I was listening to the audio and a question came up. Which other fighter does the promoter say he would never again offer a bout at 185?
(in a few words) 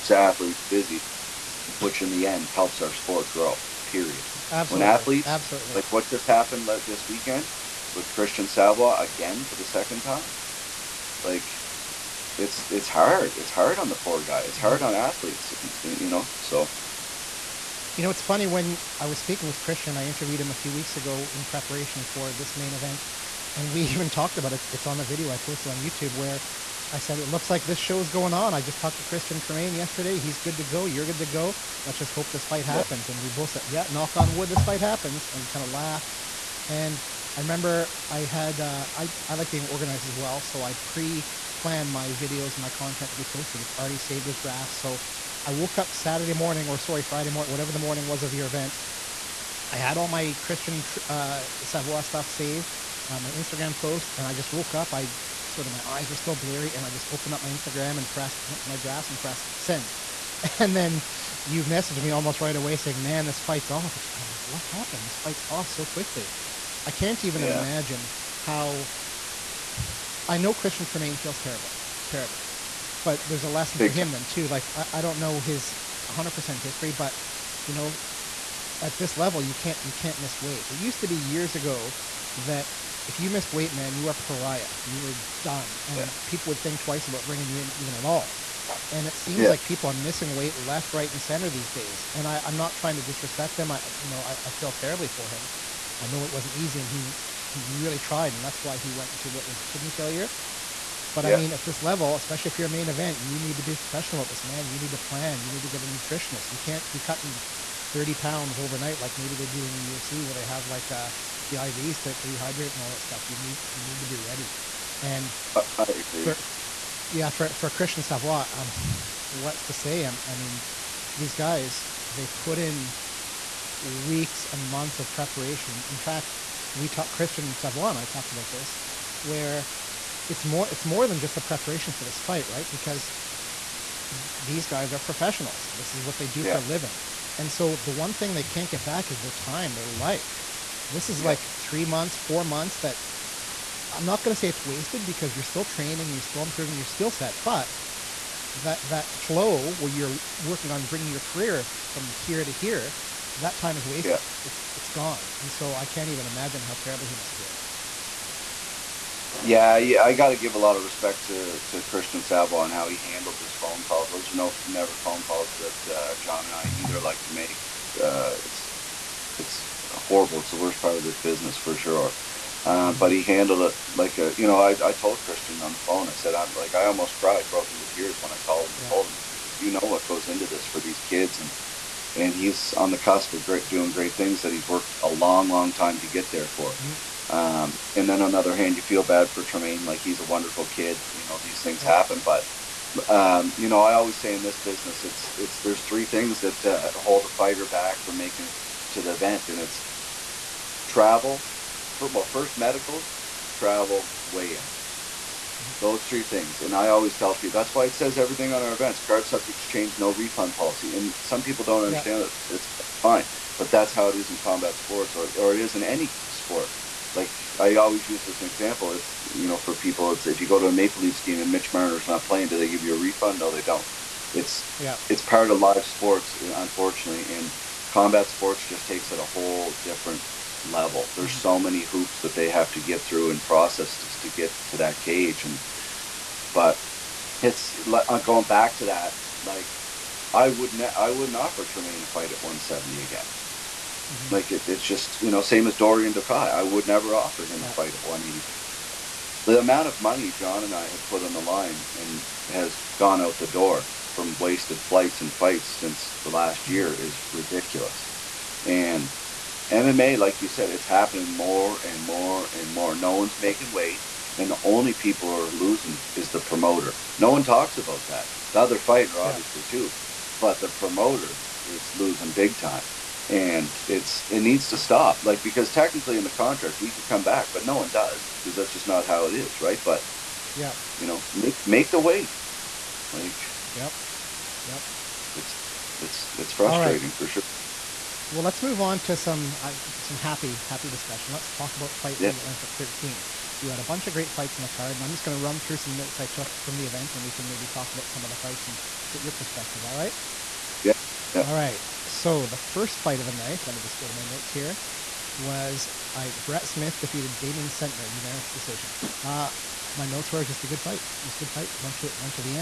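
Dorian Ducay.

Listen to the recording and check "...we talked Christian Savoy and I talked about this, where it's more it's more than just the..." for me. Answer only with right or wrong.
right.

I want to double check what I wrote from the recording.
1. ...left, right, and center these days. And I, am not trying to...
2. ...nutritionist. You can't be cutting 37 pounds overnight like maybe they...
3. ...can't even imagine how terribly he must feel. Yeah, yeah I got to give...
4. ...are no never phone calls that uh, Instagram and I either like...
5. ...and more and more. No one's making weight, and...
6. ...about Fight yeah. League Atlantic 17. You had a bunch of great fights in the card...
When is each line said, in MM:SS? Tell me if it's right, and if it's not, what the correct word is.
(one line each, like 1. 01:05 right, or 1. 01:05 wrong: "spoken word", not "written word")
1. 01:30 right
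2. 01:45 wrong: "30", not "37"
3. 02:35 right
4. 02:44 wrong: "John", not "Instagram"
5. 04:21 right
6. 04:51 wrong: "13", not "17".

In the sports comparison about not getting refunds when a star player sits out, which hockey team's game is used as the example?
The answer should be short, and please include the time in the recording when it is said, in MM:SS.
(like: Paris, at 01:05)
Maple Leafs, at 03:40.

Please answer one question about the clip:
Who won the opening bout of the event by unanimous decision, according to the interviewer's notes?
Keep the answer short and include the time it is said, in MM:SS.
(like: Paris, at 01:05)
Brett Smith, at 05:06.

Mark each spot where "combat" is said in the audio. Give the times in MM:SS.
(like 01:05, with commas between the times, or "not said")
03:34, 03:47.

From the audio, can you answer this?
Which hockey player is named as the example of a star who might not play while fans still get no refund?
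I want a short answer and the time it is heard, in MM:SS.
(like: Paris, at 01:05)
Mitch Marner, at 03:41.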